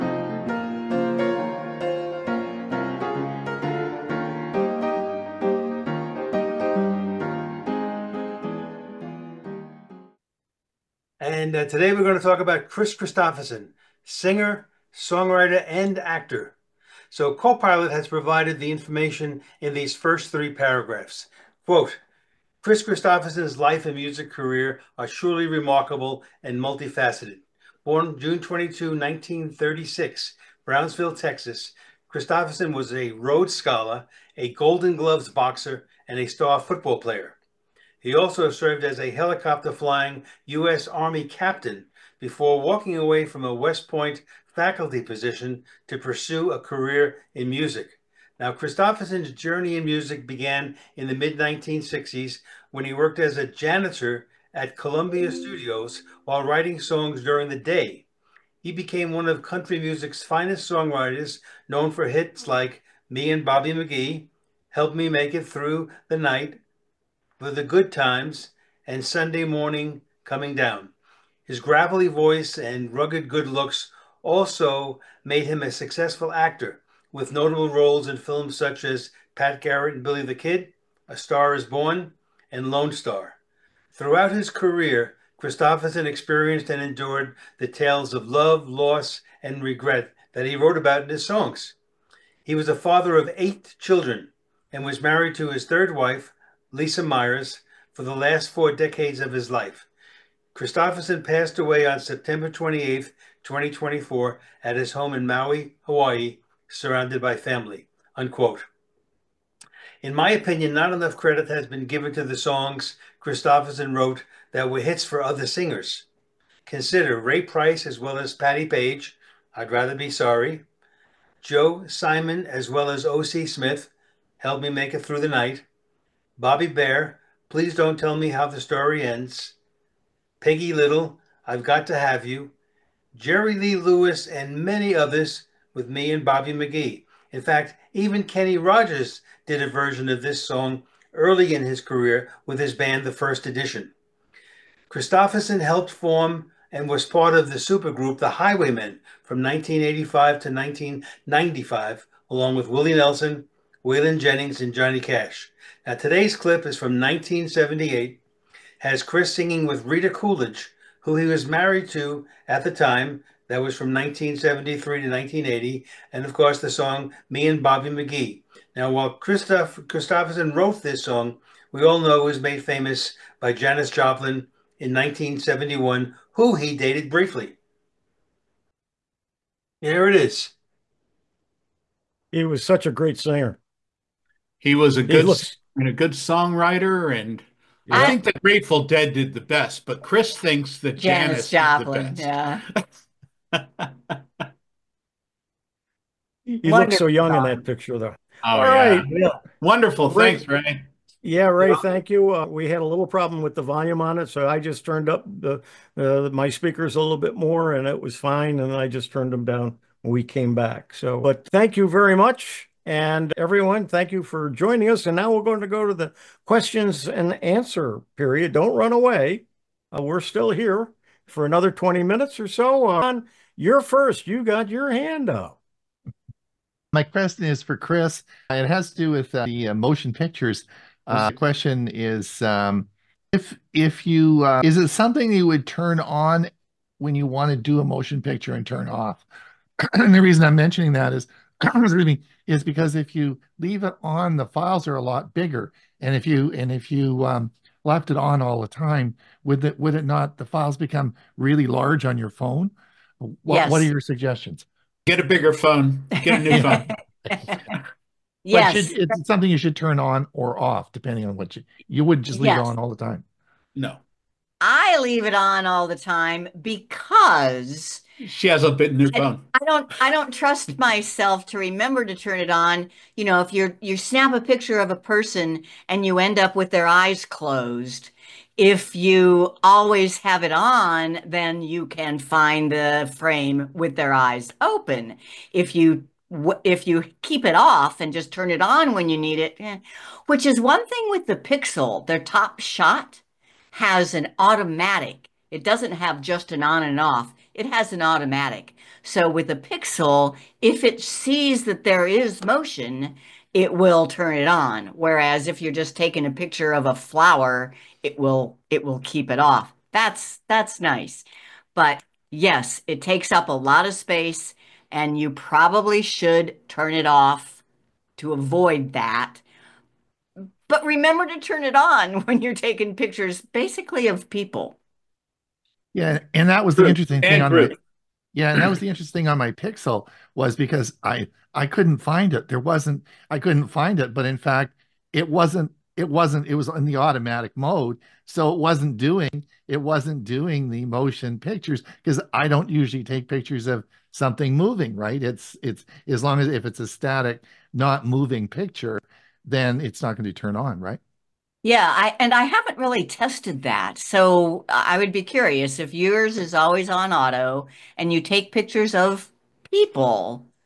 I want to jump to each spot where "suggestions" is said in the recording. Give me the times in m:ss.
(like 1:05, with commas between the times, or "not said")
4:14.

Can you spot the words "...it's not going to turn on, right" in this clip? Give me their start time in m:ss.
5:49.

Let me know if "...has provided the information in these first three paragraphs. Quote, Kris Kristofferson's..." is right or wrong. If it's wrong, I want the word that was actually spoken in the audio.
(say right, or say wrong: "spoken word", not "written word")
right.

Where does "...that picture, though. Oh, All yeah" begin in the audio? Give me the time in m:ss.
3:17.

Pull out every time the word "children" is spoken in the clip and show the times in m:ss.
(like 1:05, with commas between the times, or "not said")
1:33.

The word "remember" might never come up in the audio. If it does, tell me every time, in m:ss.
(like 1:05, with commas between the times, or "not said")
4:31, 5:20.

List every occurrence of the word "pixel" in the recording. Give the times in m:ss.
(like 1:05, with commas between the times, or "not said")
4:51, 4:59, 5:29.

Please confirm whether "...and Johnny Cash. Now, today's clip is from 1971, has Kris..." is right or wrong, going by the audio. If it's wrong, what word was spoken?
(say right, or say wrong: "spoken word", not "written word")
wrong: "1978", not "1971".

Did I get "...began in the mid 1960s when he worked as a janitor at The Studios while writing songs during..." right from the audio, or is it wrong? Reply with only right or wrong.
wrong.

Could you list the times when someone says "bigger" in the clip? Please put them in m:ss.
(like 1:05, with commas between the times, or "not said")
4:05, 4:15.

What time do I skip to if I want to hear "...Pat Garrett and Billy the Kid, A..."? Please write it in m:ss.
1:19.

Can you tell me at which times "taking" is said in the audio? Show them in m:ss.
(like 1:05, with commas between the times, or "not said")
5:05, 5:22.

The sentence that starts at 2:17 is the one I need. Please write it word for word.
In fact, even Kenny Rogers did a version of this song early in his career with his band The First Edition.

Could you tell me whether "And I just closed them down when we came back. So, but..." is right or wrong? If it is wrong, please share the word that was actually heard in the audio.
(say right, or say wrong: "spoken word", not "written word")
wrong: "turned", not "closed".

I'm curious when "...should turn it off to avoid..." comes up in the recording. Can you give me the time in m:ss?
5:16.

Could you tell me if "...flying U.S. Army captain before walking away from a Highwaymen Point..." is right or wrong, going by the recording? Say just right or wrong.
wrong.